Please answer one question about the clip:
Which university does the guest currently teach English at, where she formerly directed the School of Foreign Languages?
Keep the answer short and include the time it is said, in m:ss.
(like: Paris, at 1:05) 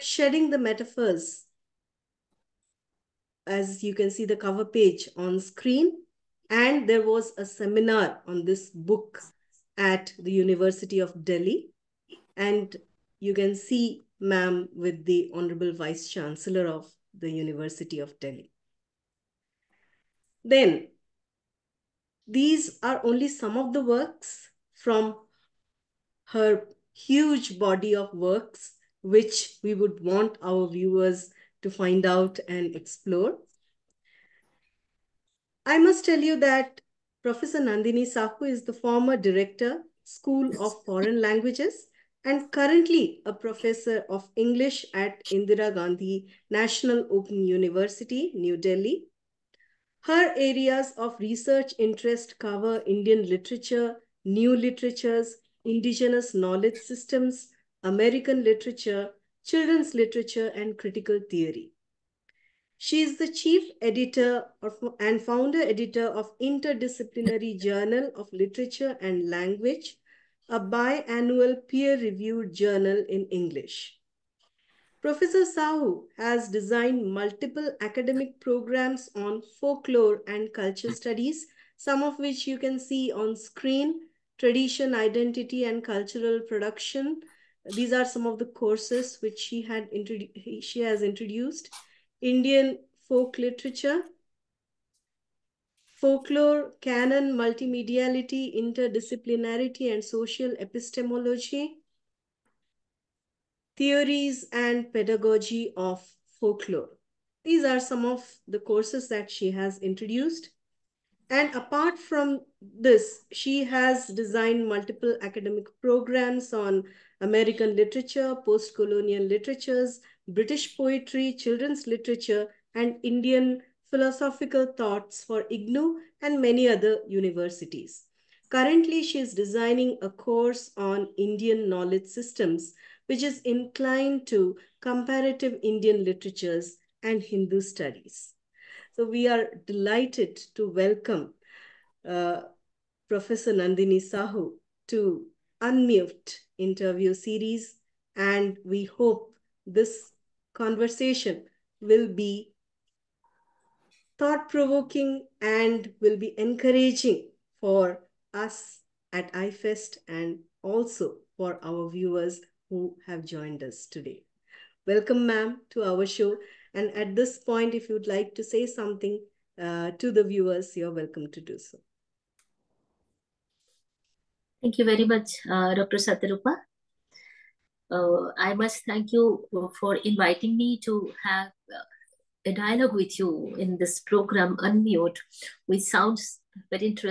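Indira Gandhi National Open University, at 0:45.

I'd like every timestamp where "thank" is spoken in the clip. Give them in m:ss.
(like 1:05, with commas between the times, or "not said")
2:54, 2:58.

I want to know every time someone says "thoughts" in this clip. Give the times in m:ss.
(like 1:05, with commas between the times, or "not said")
2:04, 2:34.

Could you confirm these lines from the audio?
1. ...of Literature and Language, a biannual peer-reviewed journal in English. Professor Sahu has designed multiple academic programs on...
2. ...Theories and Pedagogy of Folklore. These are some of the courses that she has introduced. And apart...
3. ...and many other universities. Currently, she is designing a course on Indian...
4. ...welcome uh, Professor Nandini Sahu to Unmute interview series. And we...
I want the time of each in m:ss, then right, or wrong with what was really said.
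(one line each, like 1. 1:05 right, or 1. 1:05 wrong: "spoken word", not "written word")
1. 1:08 right
2. 1:43 right
3. 2:06 right
4. 2:20 right.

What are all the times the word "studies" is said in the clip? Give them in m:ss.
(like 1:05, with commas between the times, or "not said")
1:20, 2:17.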